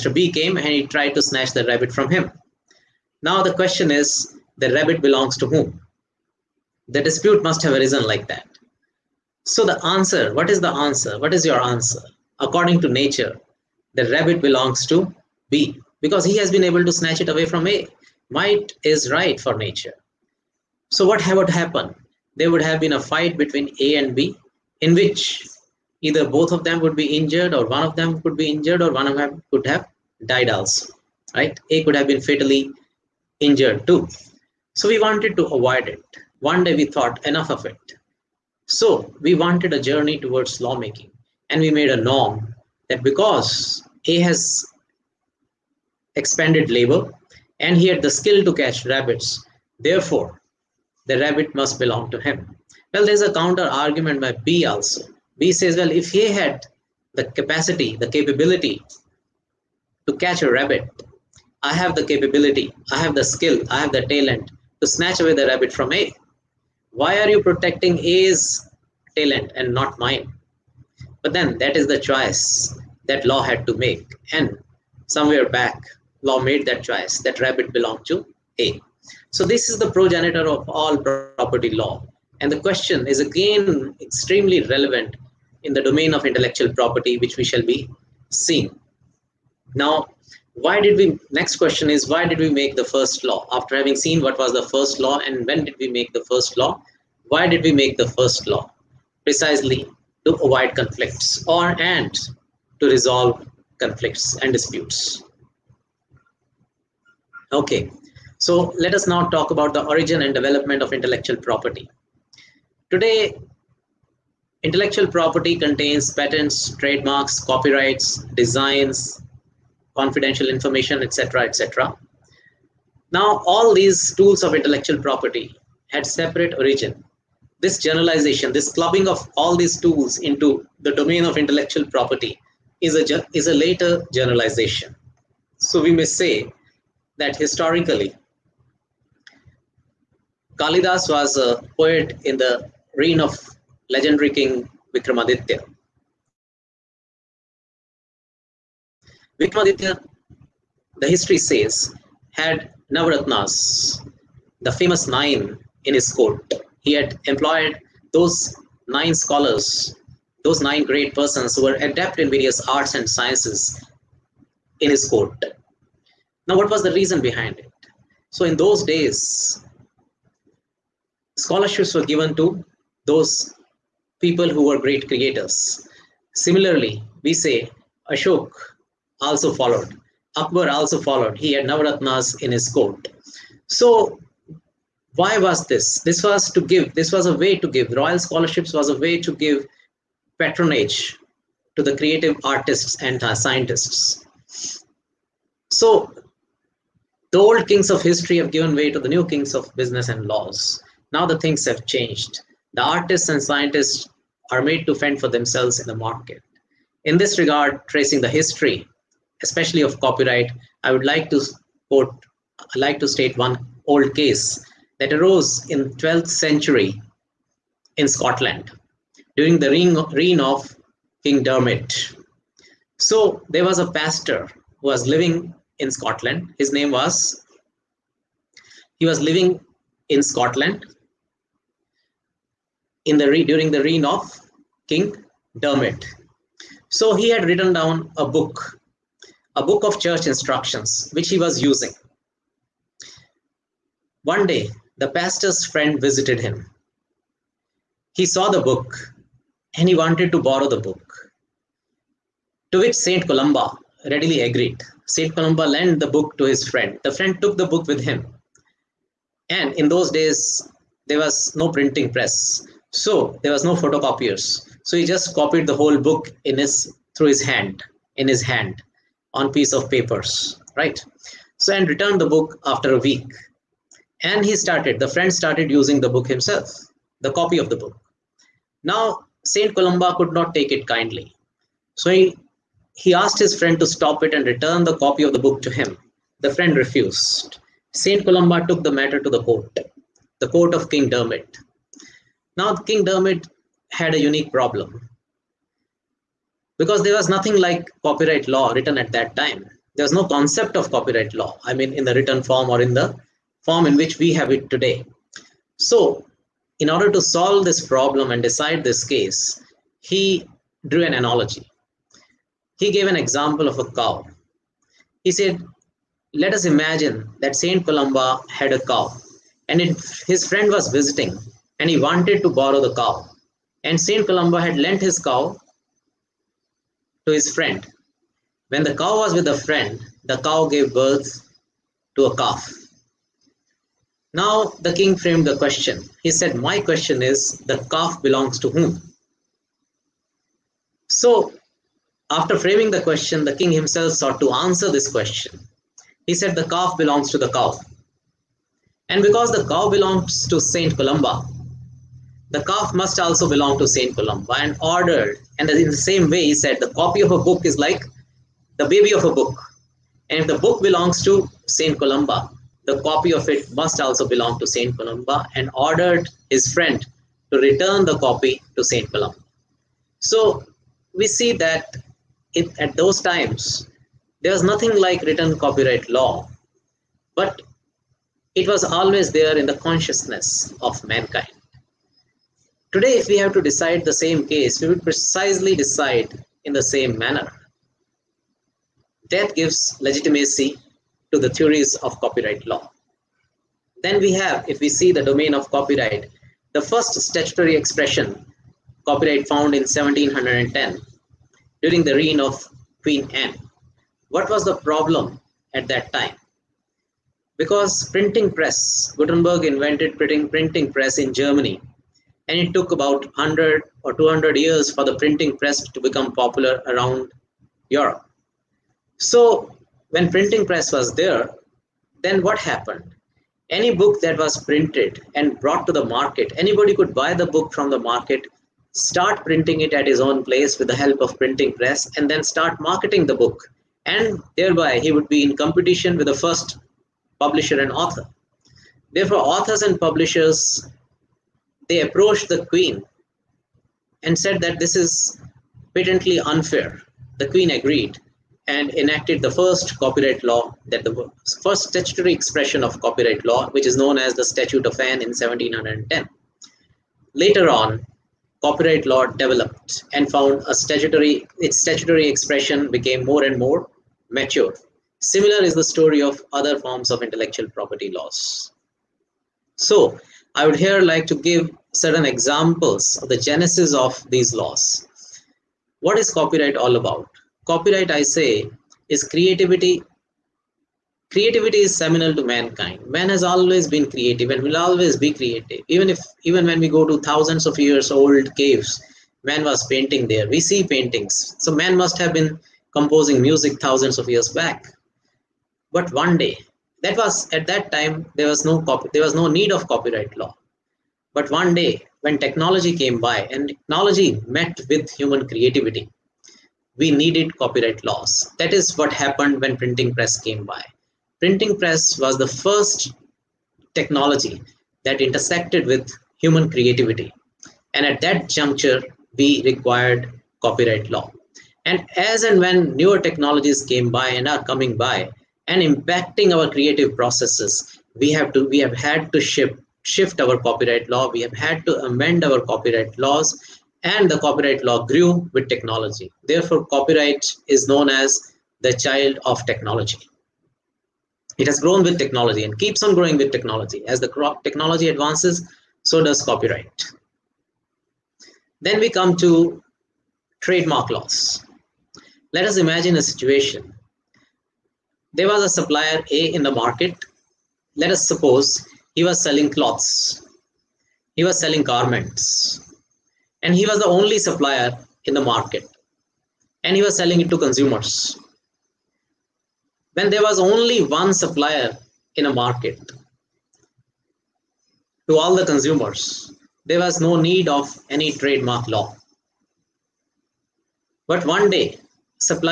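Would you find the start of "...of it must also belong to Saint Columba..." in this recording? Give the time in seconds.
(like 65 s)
363 s.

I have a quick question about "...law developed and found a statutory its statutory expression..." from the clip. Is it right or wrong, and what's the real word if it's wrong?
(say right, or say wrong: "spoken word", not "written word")
right.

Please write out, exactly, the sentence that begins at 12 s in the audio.
According to nature, the rabbit belongs to B because he has been able to snatch it away from A.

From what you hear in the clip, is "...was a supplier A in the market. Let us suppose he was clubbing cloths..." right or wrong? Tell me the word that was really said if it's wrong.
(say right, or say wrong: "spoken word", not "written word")
wrong: "selling", not "clubbing".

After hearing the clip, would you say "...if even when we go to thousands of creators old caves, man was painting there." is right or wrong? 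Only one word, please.
wrong.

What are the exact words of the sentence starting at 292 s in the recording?
Now, King Dermot had a unique problem because there was nothing like copyright law written at that time.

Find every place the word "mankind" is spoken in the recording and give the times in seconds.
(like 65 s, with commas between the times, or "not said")
381 s, 482 s.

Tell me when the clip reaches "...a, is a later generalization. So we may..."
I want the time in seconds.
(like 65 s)
133 s.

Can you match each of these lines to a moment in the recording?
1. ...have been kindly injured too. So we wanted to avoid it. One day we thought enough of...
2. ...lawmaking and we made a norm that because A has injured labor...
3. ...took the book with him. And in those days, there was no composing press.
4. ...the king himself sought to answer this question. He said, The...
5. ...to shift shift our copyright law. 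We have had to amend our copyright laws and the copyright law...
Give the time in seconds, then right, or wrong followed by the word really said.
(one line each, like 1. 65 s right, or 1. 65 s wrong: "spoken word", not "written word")
1. 31 s wrong: "fatally", not "kindly"
2. 40 s wrong: "expanded", not "injured"
3. 257 s wrong: "printing", not "composing"
4. 343 s right
5. 529 s right.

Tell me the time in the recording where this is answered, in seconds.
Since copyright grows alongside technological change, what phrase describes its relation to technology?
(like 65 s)
538 s.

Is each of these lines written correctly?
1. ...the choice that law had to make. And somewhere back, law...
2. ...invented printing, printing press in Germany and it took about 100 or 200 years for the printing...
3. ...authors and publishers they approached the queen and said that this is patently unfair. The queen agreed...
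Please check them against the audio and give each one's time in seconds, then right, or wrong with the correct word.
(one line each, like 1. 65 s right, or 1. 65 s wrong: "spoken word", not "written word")
1. 71 s right
2. 409 s right
3. 439 s right.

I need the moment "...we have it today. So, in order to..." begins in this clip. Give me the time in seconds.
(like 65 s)
304 s.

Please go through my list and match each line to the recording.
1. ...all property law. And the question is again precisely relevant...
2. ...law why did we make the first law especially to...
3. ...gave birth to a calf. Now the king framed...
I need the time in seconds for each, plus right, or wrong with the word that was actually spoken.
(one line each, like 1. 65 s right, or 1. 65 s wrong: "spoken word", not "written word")
1. 80 s wrong: "extremely", not "precisely"
2. 96 s wrong: "precisely", not "especially"
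3. 330 s right.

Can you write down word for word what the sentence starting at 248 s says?
He saw the book and he wanted to borrow the book, to which St.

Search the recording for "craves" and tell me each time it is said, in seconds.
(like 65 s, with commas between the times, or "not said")
not said.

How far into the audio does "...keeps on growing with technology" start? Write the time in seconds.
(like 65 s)
542 s.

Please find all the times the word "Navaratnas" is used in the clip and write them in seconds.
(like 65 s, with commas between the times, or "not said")
152 s, 181 s.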